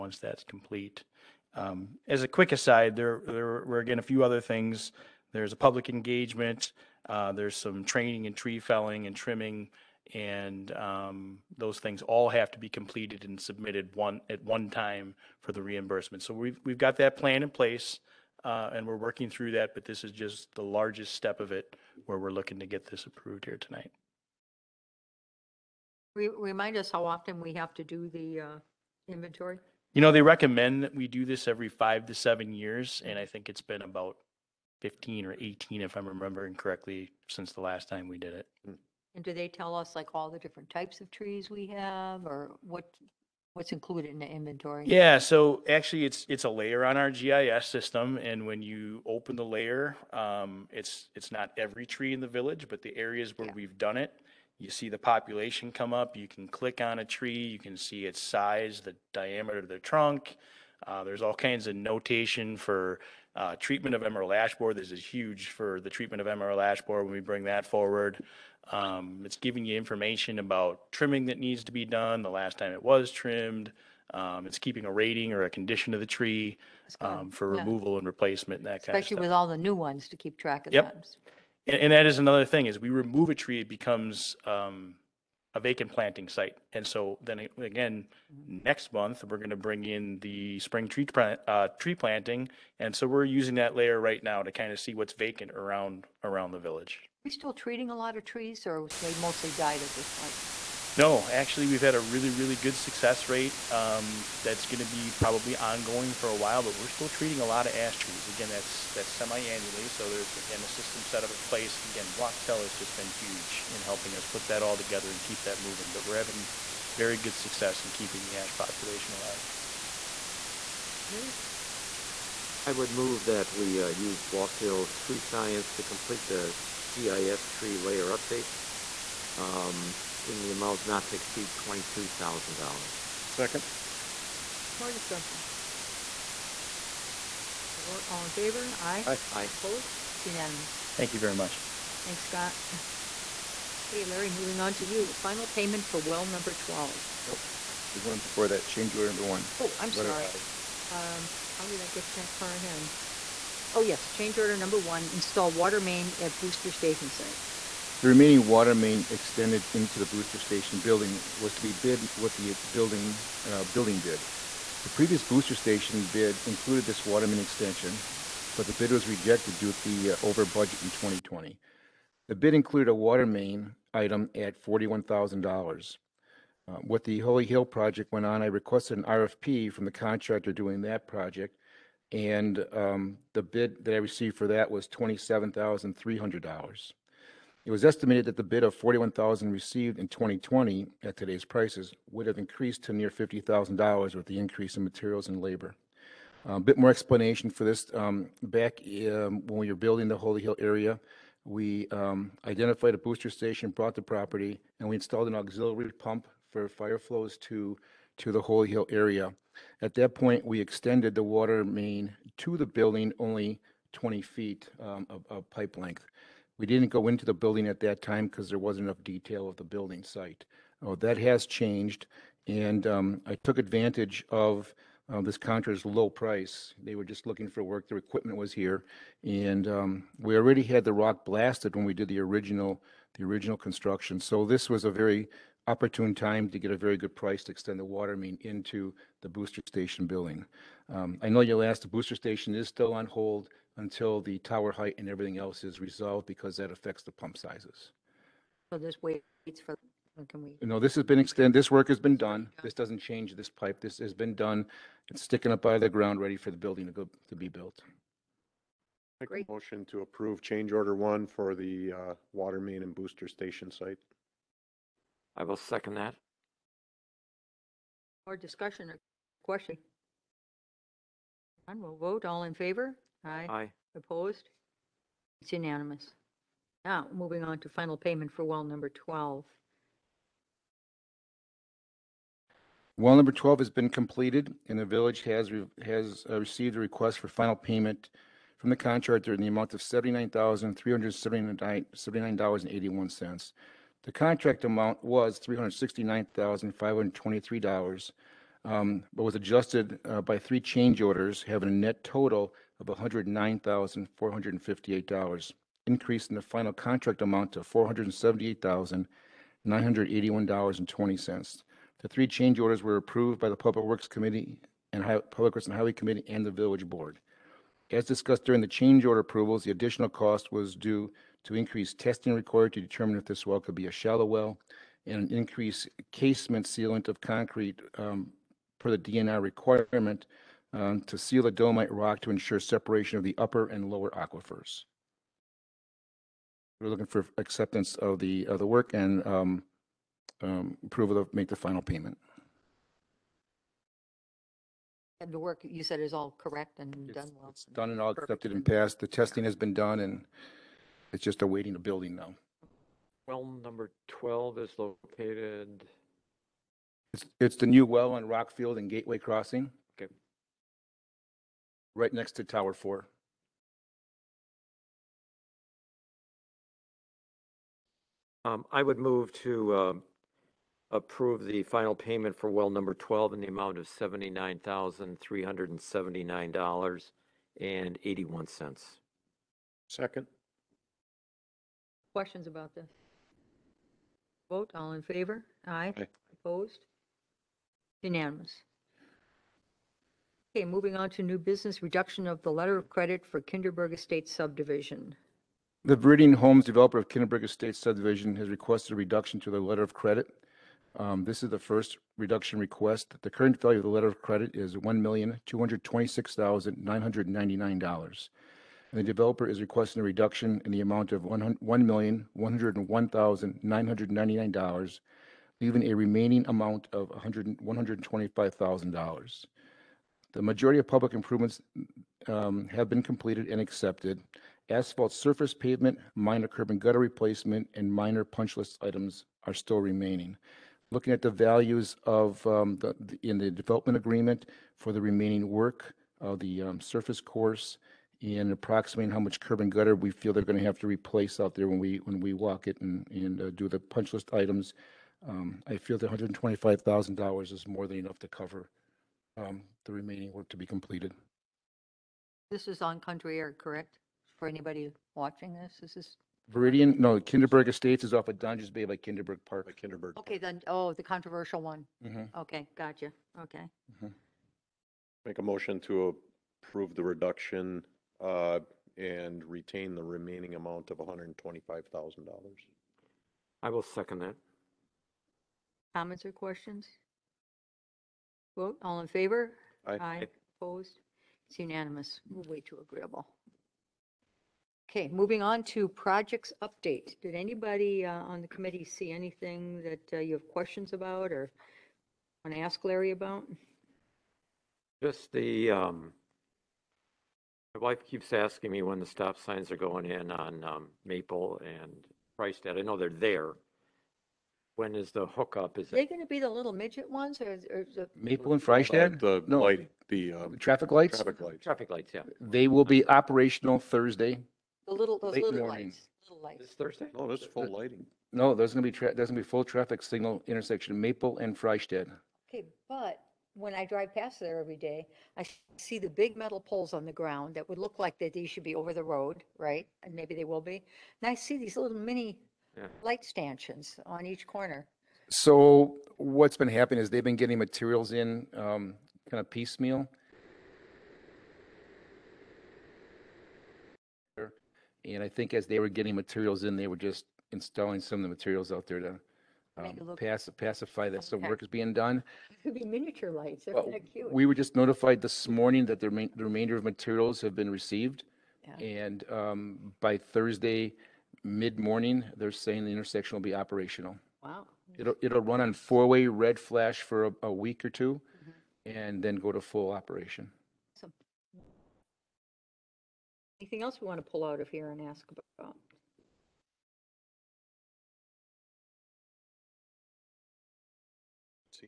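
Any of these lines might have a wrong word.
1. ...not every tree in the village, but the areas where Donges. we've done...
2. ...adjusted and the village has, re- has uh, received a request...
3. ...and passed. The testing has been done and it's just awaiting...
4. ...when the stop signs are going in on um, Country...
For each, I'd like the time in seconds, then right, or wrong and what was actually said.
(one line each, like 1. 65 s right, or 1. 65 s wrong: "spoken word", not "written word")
1. 51 s wrong: "Yeah", not "Donges"
2. 283 s wrong: "completed", not "adjusted"
3. 348 s right
4. 498 s wrong: "Maple", not "Country".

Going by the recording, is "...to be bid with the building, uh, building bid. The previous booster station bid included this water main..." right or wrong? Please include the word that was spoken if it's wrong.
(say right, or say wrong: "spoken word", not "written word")
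right.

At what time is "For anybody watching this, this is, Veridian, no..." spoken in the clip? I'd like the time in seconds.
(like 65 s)
454 s.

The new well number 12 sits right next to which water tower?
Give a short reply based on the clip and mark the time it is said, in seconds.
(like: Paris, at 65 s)
Tower Four, at 362 s.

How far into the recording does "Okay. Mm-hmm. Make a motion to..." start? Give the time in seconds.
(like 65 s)
463 s.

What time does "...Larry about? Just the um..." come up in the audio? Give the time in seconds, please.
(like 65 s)
492 s.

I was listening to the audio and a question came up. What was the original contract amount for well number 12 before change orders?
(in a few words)
$369,523.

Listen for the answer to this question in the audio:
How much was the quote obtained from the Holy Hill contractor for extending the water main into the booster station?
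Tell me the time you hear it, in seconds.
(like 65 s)
184 s.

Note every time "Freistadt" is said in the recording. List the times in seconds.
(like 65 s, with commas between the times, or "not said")
502 s, 508 s, 521 s.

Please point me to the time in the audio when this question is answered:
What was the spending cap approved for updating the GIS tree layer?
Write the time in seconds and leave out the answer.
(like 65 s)
131 s.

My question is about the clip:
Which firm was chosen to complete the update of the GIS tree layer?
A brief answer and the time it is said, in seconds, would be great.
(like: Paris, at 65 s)
Wachtel Tree Science, at 124 s.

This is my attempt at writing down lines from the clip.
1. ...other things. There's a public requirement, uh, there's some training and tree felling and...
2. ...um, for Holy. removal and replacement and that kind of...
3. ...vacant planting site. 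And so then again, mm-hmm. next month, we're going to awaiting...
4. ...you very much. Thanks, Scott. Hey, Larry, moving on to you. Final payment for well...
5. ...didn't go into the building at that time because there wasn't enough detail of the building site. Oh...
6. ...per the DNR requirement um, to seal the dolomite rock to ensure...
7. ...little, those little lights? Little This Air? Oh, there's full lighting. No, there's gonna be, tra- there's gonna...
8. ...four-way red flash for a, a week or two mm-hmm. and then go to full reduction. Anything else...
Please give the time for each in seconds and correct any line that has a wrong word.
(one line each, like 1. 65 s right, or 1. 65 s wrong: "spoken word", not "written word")
1. 4 s wrong: "engagement", not "requirement"
2. 76 s wrong: "Yeah", not "Holy"
3. 85 s wrong: "bring", not "awaiting"
4. 141 s right
5. 216 s right
6. 328 s right
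7. 514 s wrong: "Thursday", not "Air"
8. 565 s wrong: "operation", not "reduction".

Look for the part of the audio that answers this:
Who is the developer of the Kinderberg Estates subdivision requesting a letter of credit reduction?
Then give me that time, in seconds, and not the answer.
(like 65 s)
395 s.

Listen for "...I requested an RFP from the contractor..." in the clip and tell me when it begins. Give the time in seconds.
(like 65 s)
178 s.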